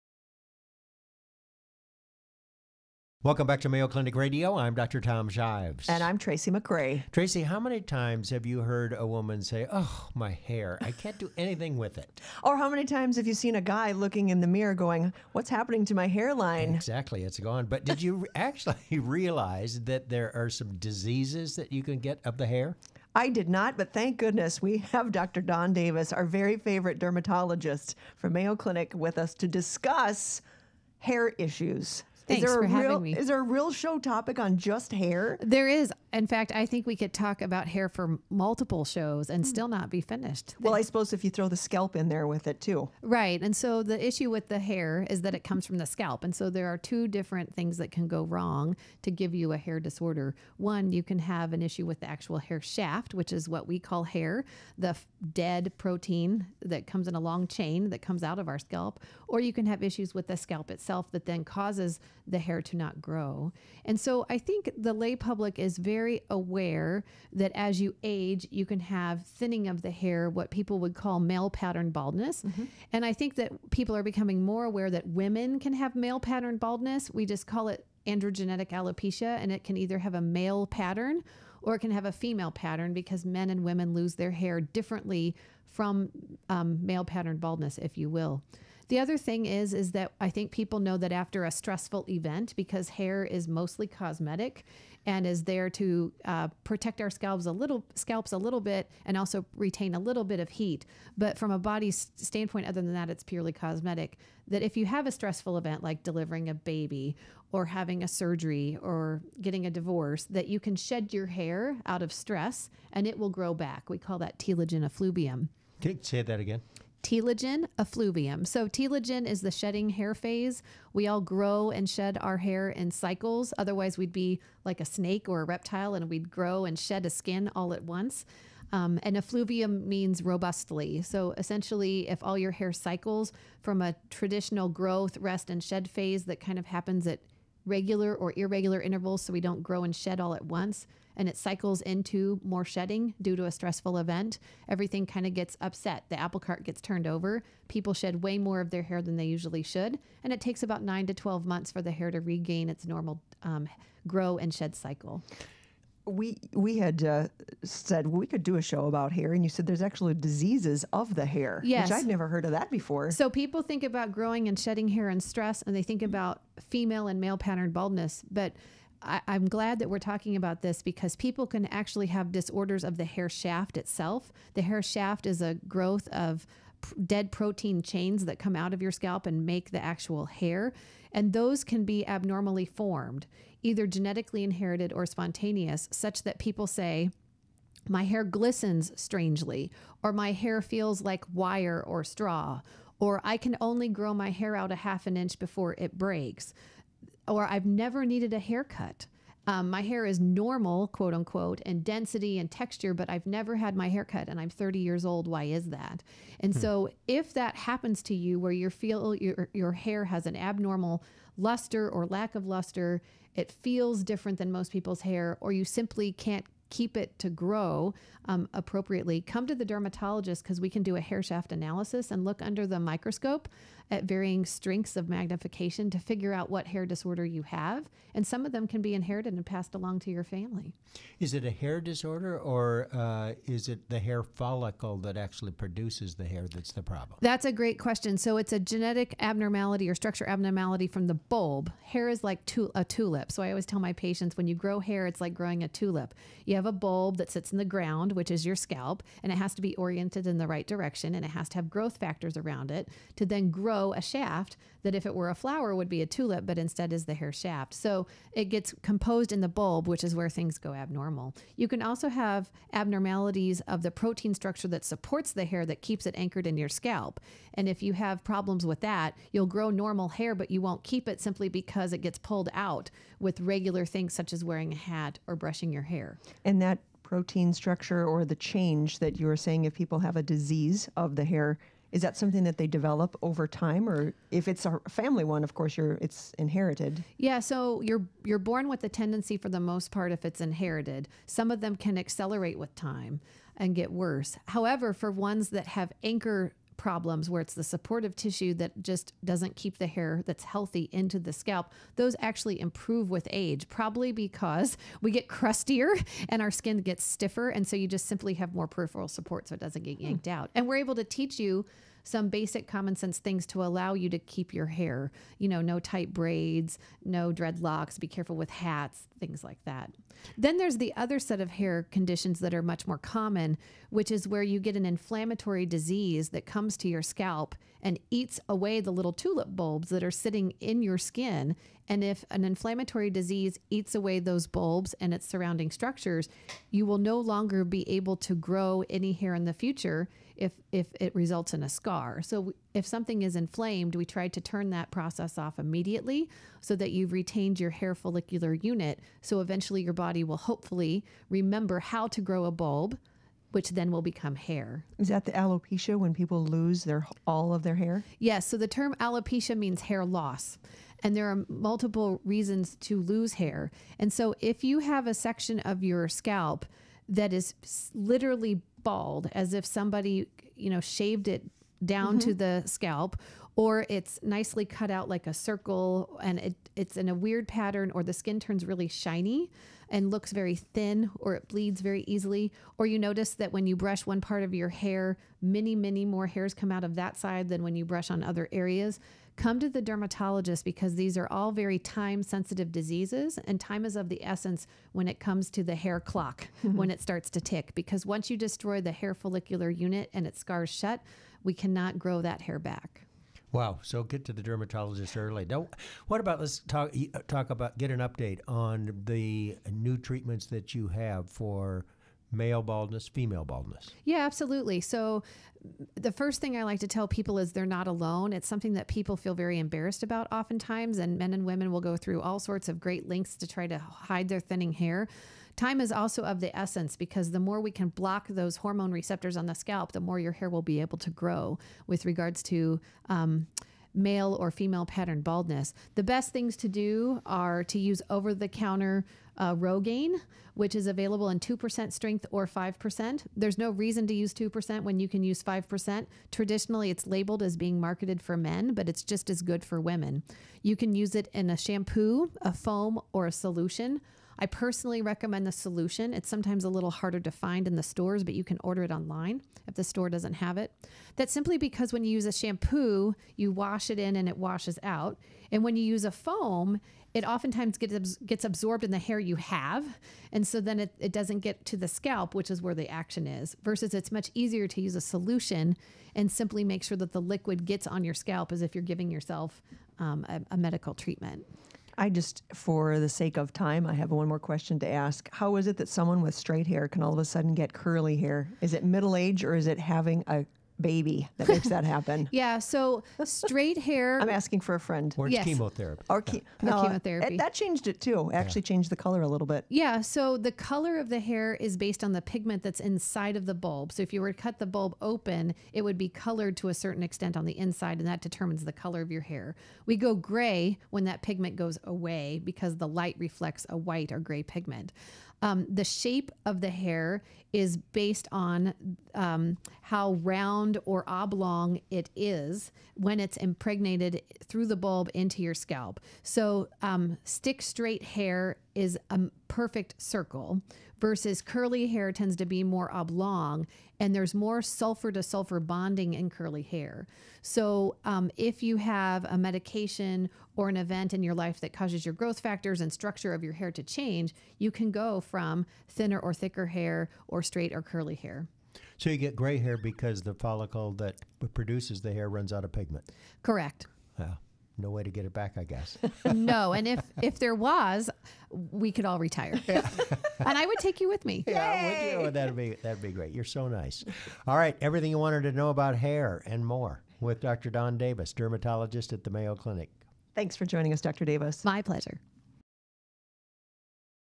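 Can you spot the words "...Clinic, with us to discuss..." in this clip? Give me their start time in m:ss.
0:28.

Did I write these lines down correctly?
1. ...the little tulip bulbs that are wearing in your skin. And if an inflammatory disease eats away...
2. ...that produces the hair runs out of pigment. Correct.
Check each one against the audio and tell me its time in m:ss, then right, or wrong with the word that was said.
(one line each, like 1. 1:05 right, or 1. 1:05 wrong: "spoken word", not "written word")
1. 5:28 wrong: "sitting", not "wearing"
2. 9:10 right.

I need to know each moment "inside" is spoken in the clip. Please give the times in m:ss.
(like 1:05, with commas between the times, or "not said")
8:22, 8:27.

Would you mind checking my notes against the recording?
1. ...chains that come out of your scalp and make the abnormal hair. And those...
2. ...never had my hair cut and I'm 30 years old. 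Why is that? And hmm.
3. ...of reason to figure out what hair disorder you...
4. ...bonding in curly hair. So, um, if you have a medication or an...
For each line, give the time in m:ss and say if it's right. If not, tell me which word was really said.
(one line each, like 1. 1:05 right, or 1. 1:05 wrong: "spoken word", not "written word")
1. 2:57 wrong: "actual", not "abnormal"
2. 3:23 right
3. 3:44 wrong: "magnification", not "reason"
4. 8:55 right.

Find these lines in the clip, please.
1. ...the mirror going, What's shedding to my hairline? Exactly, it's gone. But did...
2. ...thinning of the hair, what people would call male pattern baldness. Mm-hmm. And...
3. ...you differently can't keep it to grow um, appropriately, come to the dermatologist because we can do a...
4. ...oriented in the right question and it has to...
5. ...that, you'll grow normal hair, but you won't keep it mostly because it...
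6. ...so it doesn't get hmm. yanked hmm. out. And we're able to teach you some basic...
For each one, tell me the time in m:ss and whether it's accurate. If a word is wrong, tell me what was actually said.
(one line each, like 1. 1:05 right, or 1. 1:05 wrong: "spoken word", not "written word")
1. 0:14 wrong: "happening", not "shedding"
2. 1:09 right
3. 3:35 wrong: "simply", not "differently"
4. 4:09 wrong: "direction", not "question"
5. 4:28 wrong: "simply", not "mostly"
6. 5:09 right.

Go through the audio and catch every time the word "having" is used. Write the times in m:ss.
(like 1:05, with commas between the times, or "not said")
0:32, 1:47, 8:09.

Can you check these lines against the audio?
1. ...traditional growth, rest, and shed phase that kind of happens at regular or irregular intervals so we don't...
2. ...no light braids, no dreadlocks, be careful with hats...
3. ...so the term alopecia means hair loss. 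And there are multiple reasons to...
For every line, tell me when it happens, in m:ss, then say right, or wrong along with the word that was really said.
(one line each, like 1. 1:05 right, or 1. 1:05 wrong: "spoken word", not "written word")
1. 2:14 right
2. 5:15 wrong: "tight", not "light"
3. 5:58 right.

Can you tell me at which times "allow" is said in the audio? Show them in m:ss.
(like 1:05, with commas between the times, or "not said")
5:13.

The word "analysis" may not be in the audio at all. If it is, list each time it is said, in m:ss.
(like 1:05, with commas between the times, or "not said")
3:41.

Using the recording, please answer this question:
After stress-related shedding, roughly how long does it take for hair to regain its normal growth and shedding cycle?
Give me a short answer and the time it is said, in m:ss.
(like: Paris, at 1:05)
9 to 12 months, at 2:30.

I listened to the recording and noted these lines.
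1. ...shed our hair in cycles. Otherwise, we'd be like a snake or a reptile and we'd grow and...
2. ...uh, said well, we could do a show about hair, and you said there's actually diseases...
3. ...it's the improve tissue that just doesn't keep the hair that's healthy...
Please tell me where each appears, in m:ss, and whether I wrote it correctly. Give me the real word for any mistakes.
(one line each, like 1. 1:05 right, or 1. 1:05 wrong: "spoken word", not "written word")
1. 2:01 right
2. 2:37 right
3. 4:57 wrong: "supportive", not "improve".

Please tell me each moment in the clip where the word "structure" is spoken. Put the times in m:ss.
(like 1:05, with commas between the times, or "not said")
3:59, 4:24, 4:37, 5:35, 9:02.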